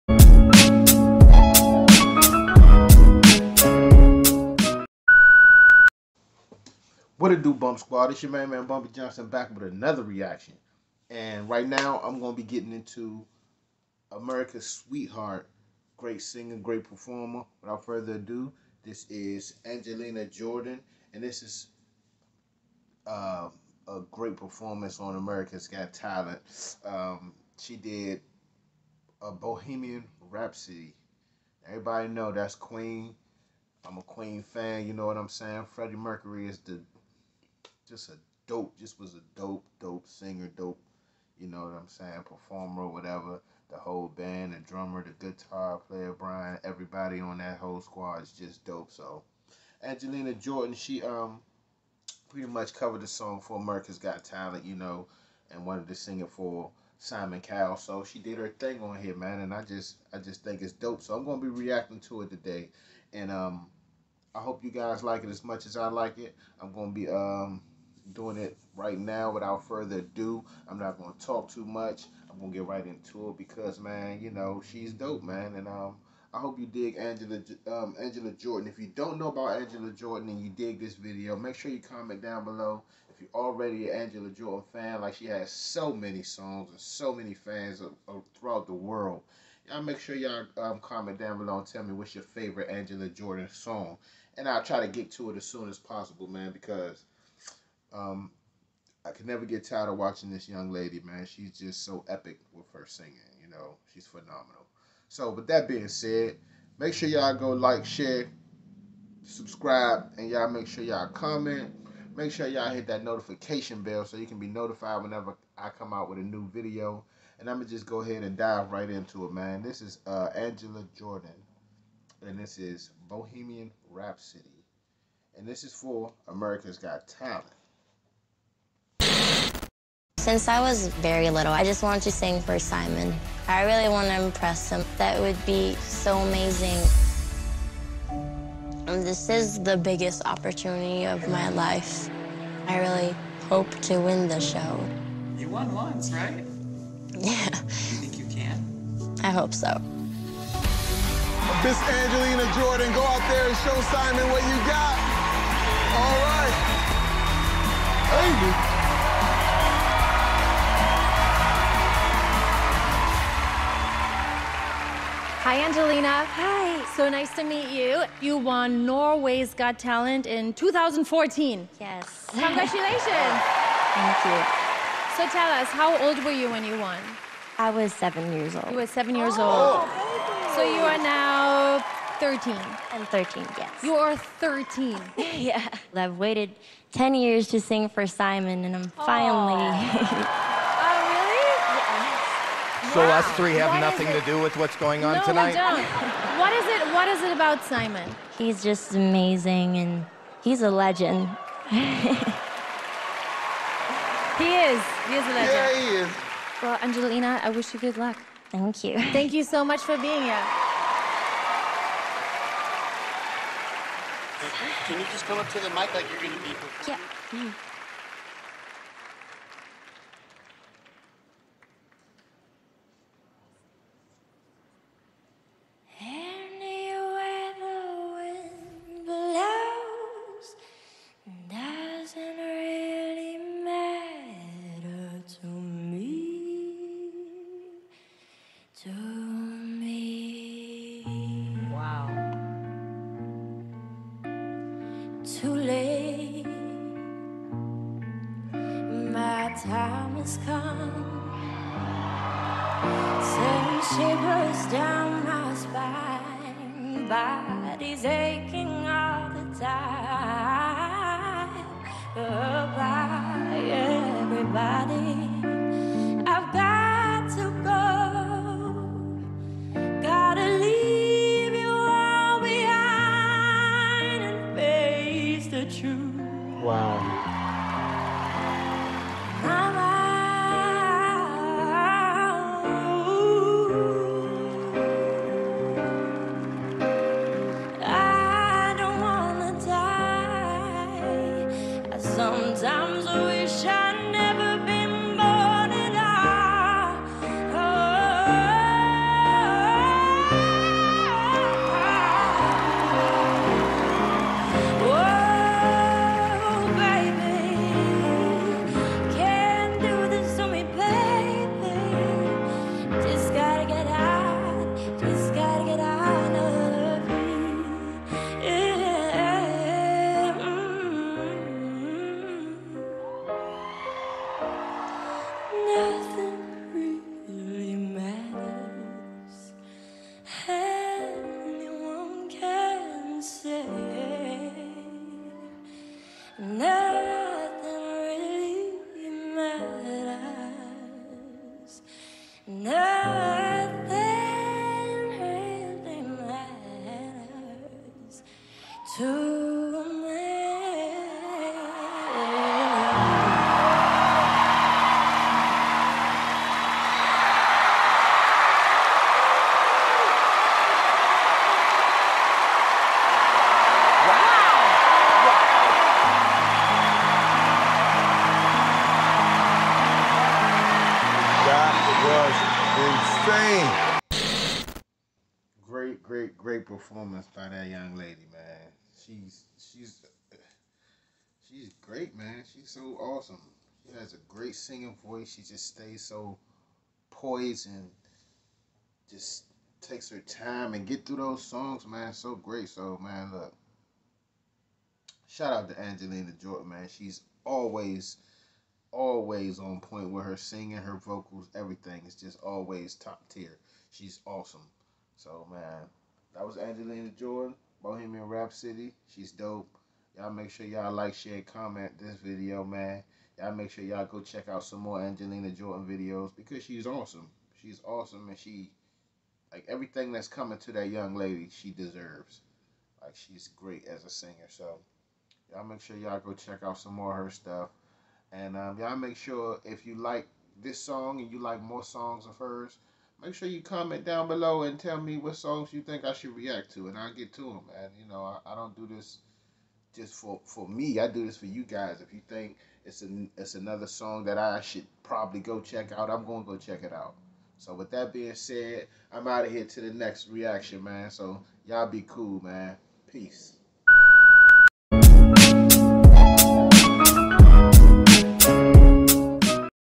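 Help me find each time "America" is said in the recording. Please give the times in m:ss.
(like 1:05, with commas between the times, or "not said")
0:14, 0:25, 0:53, 2:06.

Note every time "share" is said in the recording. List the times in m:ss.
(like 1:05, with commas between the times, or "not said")
1:47, 6:51.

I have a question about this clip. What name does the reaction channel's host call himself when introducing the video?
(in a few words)
Bumpy Johnson.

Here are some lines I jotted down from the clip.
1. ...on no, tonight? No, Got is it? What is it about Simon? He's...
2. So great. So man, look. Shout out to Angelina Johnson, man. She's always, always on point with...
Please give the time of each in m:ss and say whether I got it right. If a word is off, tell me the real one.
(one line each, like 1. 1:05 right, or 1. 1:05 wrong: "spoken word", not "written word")
1. 3:15 wrong: "What", not "Got"
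2. 6:32 wrong: "Jordan", not "Johnson".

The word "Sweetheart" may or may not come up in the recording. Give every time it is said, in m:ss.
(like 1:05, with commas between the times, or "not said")
0:14.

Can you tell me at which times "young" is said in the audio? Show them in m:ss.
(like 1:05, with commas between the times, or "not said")
1:40, 6:17, 7:00.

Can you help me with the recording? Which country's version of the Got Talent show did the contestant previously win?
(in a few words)
Norway.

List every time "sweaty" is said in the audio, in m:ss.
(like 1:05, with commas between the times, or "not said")
not said.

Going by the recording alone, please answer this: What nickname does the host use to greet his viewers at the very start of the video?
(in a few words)
Bump Squad.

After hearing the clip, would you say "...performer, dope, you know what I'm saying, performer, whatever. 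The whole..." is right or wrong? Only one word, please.
wrong.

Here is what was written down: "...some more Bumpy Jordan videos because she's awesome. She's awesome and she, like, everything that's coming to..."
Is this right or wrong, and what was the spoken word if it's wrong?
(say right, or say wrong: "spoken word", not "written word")
wrong: "Angelina", not "Bumpy".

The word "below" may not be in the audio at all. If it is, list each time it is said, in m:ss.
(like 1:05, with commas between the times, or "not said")
1:22, 1:31, 7:14.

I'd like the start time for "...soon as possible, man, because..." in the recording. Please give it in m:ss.
1:35.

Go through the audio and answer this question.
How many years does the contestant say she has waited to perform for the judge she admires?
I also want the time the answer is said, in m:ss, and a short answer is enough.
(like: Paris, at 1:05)
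10, at 3:06.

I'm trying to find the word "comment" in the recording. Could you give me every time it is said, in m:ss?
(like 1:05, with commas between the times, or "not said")
1:21, 1:30, 1:51, 6:51, 7:13.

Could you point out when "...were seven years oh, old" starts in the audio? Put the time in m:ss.
2:58.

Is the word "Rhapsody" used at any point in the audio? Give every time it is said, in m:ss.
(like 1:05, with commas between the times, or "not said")
0:30, 2:03, 6:48.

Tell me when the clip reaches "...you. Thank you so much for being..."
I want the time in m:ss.
3:28.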